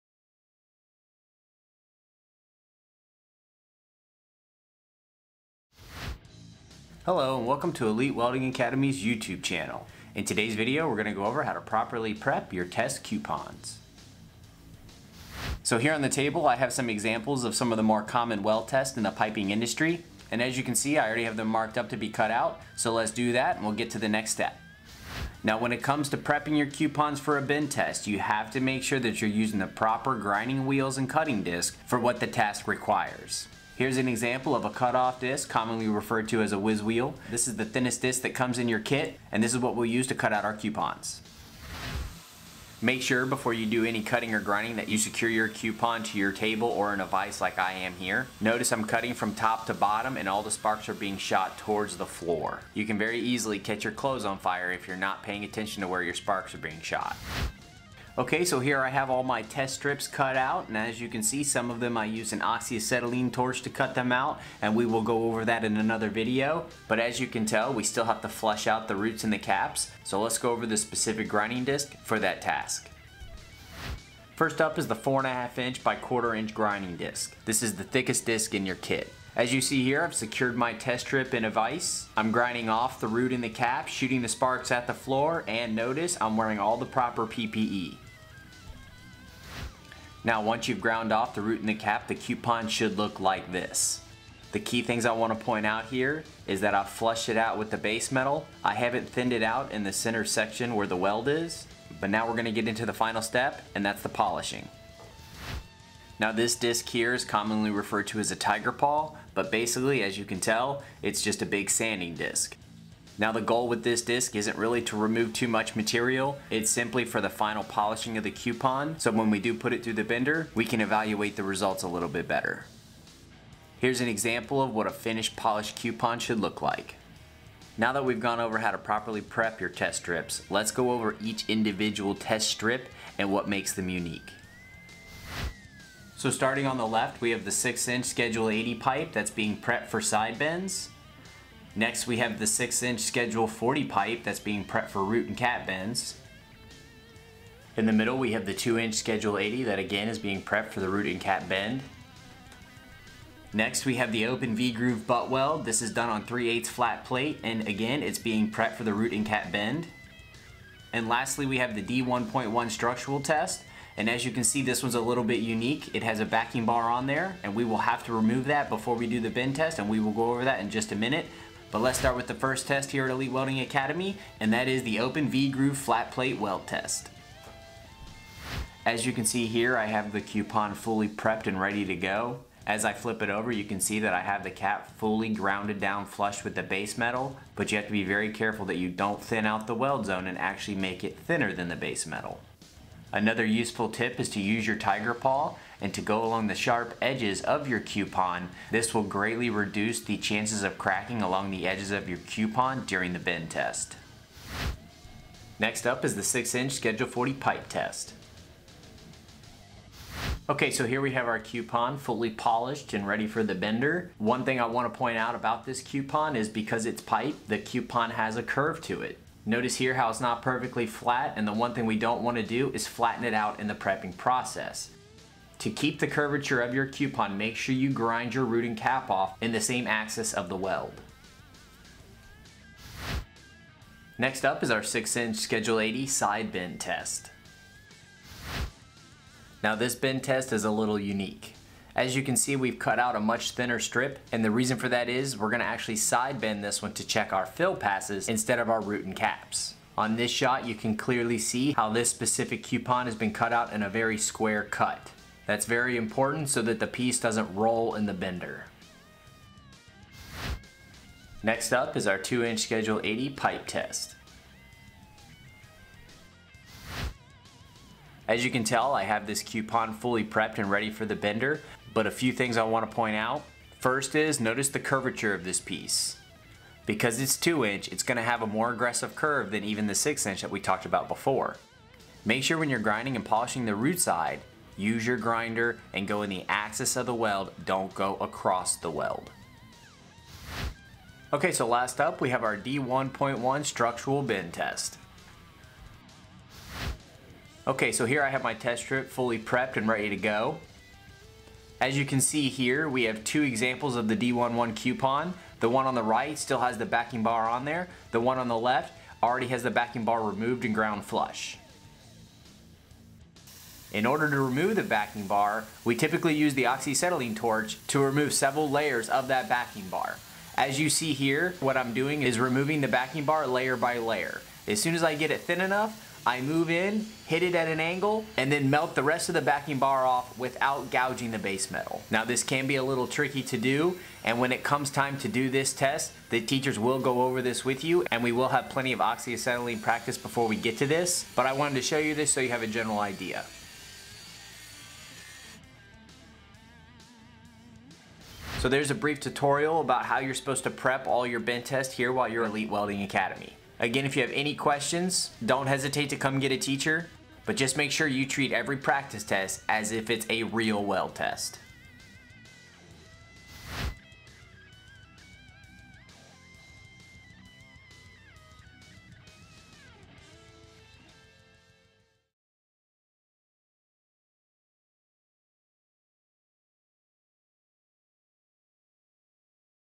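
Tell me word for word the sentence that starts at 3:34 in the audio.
One thing I wanna point out about this coupon is because it's pipe, the coupon has a curve to it.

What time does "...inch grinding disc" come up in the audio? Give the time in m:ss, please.
1:16.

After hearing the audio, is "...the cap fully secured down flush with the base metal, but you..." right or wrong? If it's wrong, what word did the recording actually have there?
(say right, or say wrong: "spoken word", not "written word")
wrong: "grounded", not "secured".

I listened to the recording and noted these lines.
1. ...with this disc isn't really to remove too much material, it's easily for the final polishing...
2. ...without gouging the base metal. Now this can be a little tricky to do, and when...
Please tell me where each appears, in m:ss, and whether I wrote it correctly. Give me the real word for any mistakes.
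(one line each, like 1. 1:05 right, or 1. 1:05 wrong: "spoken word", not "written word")
1. 1:53 wrong: "simply", not "easily"
2. 5:30 right.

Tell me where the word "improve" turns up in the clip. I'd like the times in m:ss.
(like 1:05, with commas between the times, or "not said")
not said.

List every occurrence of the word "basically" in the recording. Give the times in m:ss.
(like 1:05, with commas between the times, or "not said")
1:49.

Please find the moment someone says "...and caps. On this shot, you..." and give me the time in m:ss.
4:09.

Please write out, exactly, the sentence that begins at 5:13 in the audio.
In order to remove the backing bar, we typically use the oxyacetylene torch to remove several layers of that backing bar.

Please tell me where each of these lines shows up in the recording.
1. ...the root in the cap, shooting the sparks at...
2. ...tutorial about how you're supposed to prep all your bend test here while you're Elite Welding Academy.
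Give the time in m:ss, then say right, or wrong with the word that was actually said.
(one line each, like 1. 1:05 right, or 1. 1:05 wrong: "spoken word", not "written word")
1. 1:22 right
2. 5:49 right.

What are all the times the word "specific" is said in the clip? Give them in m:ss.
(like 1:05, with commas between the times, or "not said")
1:10, 4:12.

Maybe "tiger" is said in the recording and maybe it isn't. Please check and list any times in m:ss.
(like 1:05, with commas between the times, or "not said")
1:48, 3:14.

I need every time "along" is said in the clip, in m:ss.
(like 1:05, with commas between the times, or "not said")
3:16, 3:21.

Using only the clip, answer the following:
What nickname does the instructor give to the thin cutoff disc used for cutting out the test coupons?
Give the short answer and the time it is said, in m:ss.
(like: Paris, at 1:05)
whiz wheel, at 0:36.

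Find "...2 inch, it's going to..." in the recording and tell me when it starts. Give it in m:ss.
4:37.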